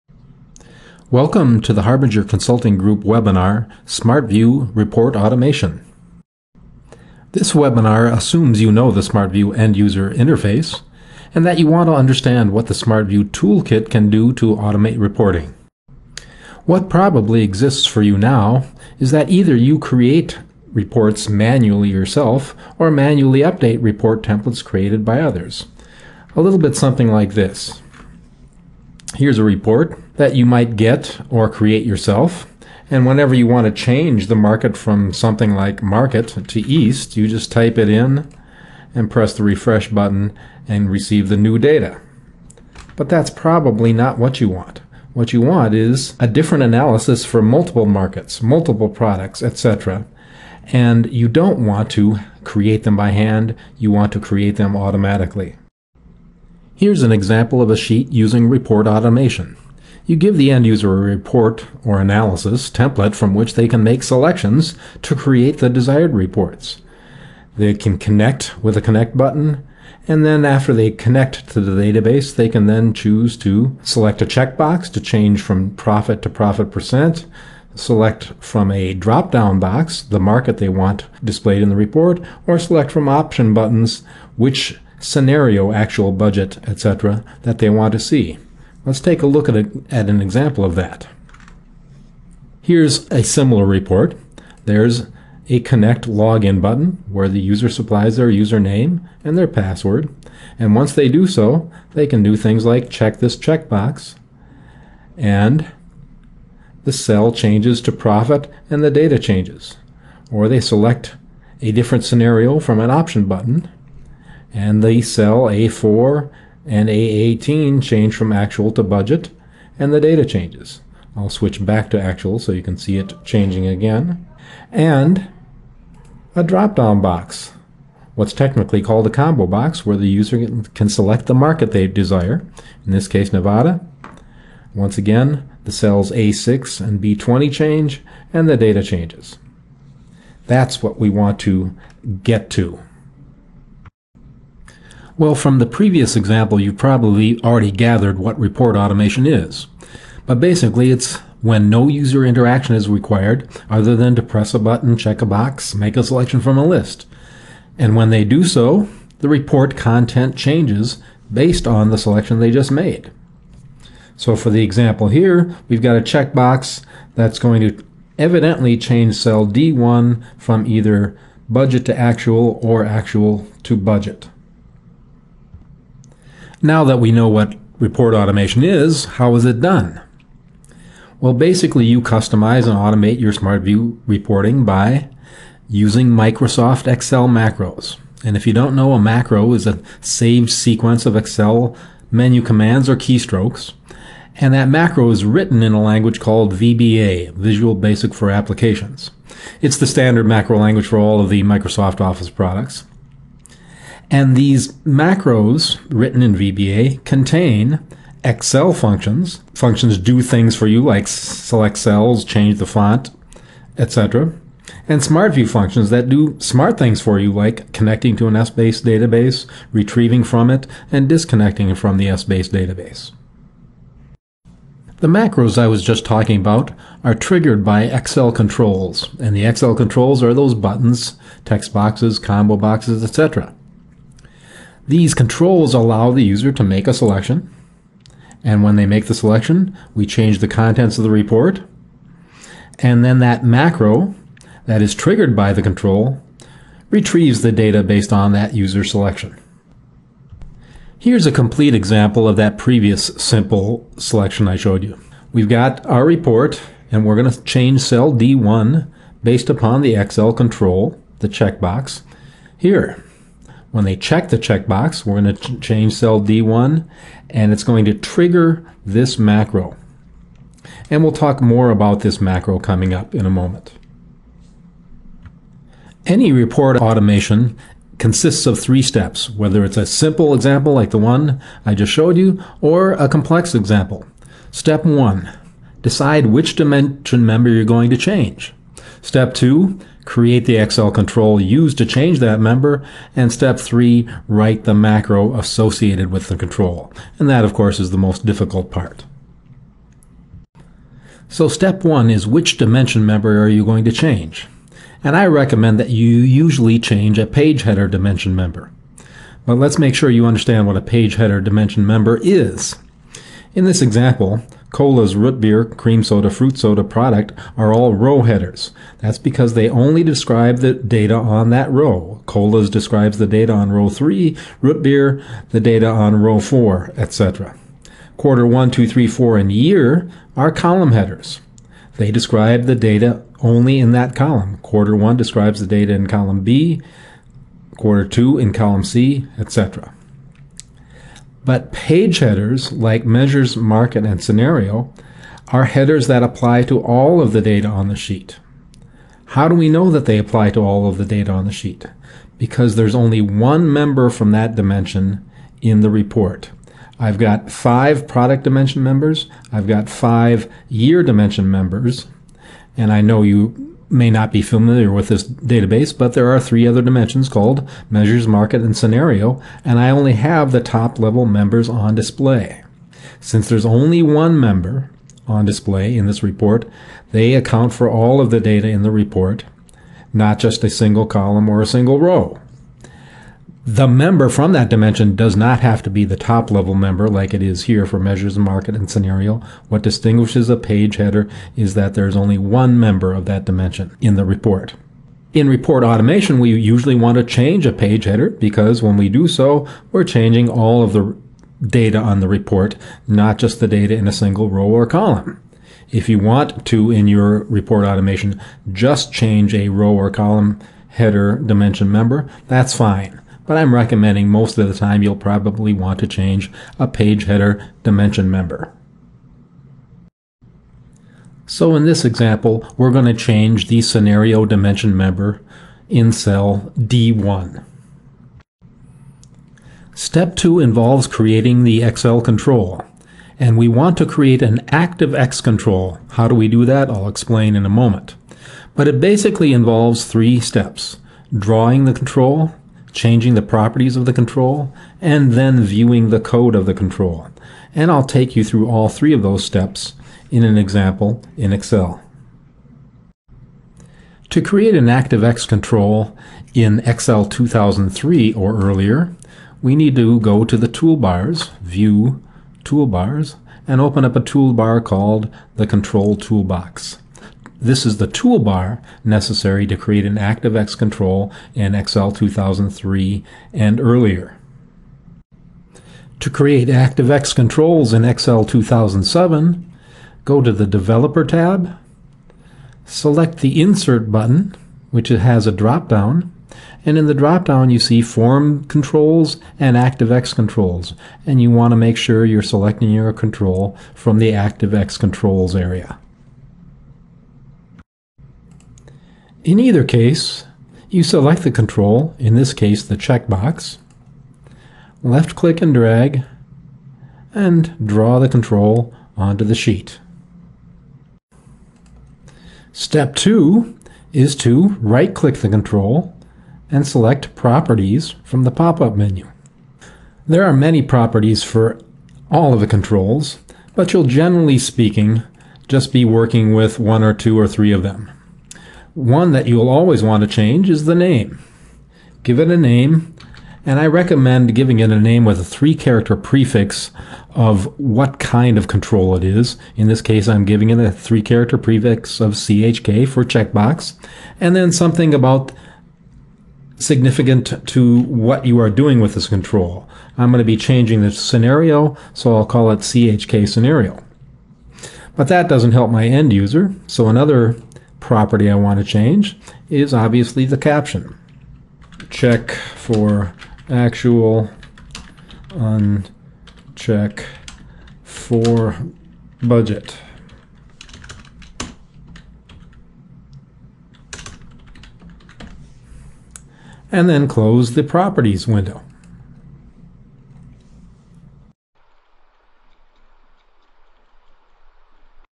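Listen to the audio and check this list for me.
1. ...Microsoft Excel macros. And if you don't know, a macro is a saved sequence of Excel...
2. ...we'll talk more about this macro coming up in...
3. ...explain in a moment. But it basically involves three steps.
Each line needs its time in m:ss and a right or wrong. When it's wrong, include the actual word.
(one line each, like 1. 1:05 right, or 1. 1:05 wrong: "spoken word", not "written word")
1. 3:06 right
2. 4:31 right
3. 7:17 right.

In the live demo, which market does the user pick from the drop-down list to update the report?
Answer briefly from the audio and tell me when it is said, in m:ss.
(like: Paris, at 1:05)
Nevada, at 2:13.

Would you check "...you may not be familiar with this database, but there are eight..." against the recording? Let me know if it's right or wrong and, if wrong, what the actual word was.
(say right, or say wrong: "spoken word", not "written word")
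wrong: "three", not "eight".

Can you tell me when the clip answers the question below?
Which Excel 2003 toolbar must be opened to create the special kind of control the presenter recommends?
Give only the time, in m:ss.
7:45.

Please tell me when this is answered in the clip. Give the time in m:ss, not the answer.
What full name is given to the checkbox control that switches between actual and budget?
9:12.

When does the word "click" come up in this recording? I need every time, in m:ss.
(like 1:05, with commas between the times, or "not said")
8:25, 8:35.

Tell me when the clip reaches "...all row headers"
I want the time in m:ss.
5:17.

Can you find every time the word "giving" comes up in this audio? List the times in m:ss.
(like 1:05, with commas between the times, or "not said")
8:54, 9:00.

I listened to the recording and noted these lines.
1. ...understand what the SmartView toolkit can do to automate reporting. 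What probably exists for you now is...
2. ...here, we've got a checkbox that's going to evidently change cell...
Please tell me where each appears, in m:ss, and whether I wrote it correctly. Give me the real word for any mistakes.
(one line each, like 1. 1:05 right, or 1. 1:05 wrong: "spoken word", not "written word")
1. 0:11 right
2. 2:45 right.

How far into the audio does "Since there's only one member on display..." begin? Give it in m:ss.
6:13.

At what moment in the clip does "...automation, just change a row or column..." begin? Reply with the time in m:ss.
6:47.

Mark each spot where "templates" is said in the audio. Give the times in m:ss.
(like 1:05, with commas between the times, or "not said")
0:24, 1:02.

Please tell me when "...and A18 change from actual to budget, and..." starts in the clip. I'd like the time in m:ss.
1:56.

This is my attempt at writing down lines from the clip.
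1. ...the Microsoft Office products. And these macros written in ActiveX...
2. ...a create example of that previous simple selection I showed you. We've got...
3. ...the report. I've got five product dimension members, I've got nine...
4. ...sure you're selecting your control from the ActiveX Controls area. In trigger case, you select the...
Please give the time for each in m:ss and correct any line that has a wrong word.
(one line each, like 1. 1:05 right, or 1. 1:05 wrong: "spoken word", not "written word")
1. 3:21 wrong: "VBA", not "ActiveX"
2. 4:11 wrong: "complete", not "create"
3. 5:55 wrong: "five", not "nine"
4. 8:11 wrong: "either", not "trigger".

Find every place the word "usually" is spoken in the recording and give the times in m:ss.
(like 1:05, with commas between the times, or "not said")
5:06, 6:36.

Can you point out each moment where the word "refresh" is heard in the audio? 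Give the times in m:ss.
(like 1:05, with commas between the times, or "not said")
0:39.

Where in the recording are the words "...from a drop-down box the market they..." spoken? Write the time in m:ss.
1:18.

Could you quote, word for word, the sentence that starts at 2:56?
Now that we know what report automation is, how is it done?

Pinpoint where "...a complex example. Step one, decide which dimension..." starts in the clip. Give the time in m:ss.
4:42.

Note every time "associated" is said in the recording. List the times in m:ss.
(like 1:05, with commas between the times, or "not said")
4:55.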